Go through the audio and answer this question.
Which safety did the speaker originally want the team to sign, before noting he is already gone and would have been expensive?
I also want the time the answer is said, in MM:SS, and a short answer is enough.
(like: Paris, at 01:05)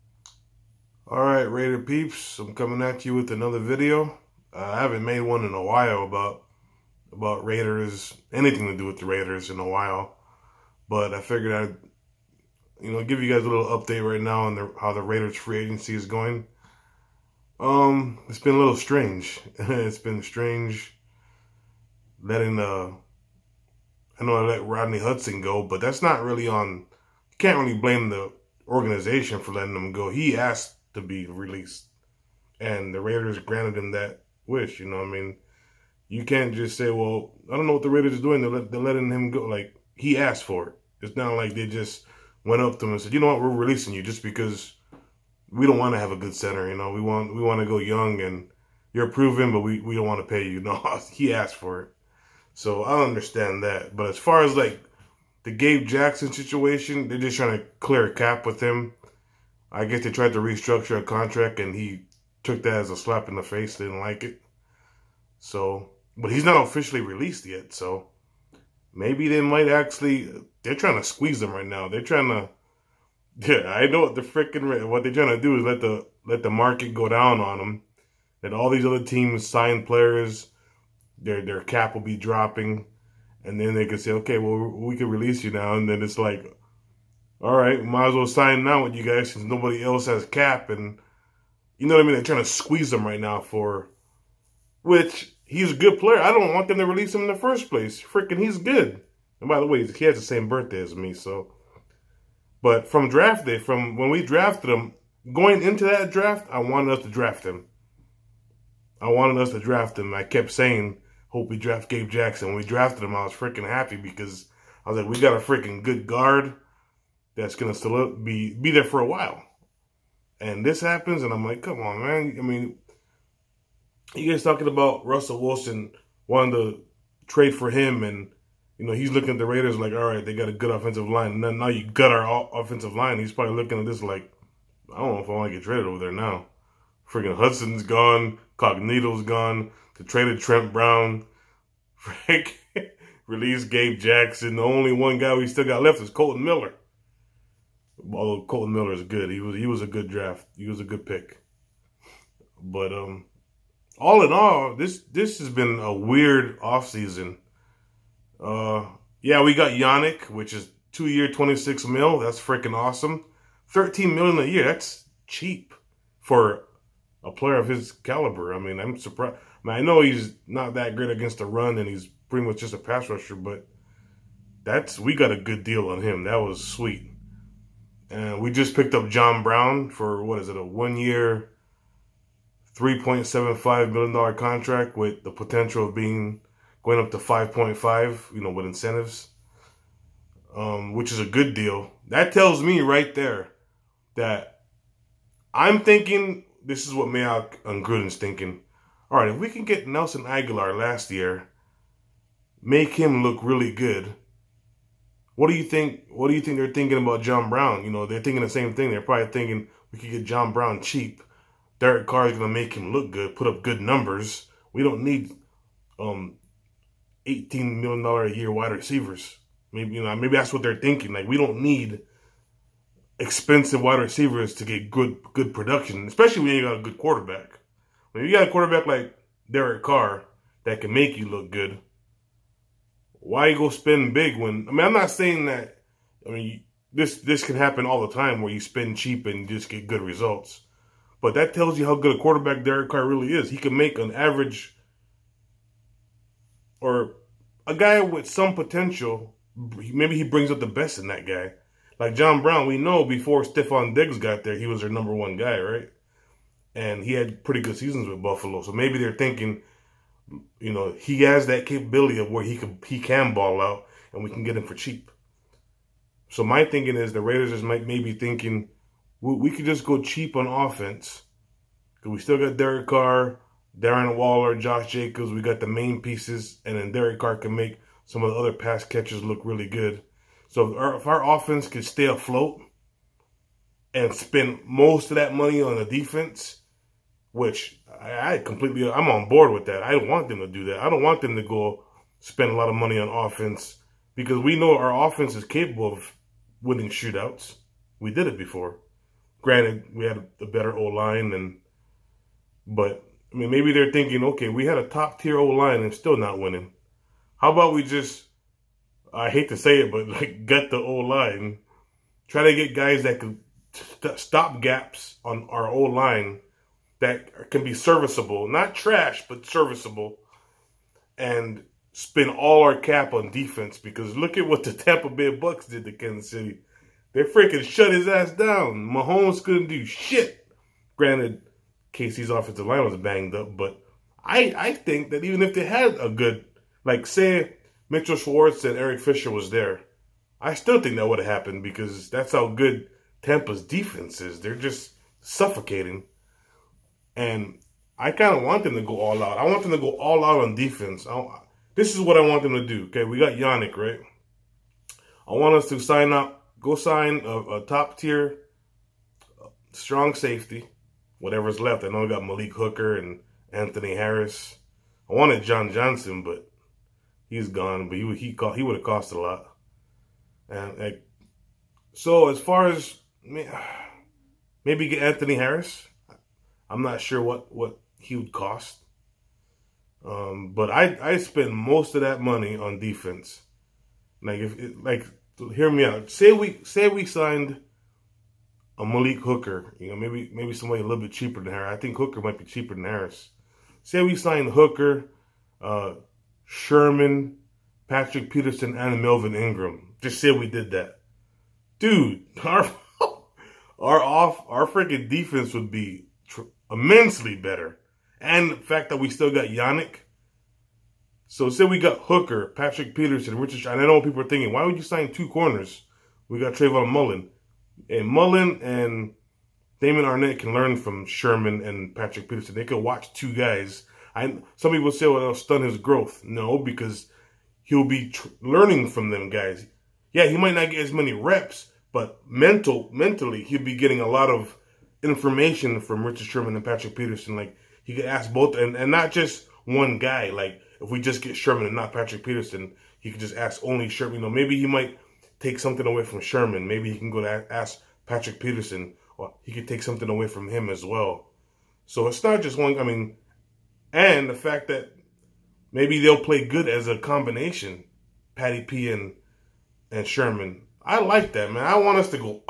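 John Johnson, at 06:05.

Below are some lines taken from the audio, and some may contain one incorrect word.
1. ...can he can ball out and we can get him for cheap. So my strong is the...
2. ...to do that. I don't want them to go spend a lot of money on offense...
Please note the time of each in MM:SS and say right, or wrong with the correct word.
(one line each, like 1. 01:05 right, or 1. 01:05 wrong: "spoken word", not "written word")
1. 04:22 wrong: "thinking", not "strong"
2. 04:50 right.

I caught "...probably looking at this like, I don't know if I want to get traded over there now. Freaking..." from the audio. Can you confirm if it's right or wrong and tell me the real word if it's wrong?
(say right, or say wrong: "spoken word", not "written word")
right.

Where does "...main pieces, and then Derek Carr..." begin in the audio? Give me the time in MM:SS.
04:35.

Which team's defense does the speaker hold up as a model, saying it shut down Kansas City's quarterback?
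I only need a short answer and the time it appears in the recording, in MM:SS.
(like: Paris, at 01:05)
Tampa Bay Bucks, at 05:24.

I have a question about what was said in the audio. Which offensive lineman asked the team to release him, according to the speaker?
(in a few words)
Rodney Hudson.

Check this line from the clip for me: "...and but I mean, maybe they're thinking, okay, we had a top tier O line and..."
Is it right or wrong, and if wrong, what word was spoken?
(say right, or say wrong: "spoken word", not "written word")
right.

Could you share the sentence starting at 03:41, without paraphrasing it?
Like we don't need expensive wide receivers to get good good production, especially when you got a good quarterback.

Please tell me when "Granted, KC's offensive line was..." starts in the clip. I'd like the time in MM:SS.
05:30.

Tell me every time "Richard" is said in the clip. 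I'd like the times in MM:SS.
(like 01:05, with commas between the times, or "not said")
06:53, 07:16.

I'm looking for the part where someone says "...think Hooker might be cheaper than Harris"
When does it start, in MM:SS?
06:31.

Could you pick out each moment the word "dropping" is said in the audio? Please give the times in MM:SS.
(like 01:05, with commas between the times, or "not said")
01:22.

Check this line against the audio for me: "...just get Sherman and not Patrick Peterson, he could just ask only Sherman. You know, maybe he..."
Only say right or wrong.
right.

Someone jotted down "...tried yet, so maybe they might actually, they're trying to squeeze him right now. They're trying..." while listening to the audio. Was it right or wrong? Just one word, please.
wrong.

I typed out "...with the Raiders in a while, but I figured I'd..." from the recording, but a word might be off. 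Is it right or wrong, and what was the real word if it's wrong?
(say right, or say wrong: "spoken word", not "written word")
right.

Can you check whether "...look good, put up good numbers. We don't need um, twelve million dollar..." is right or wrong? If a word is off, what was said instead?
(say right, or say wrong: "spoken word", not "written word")
wrong: "eighteen", not "twelve".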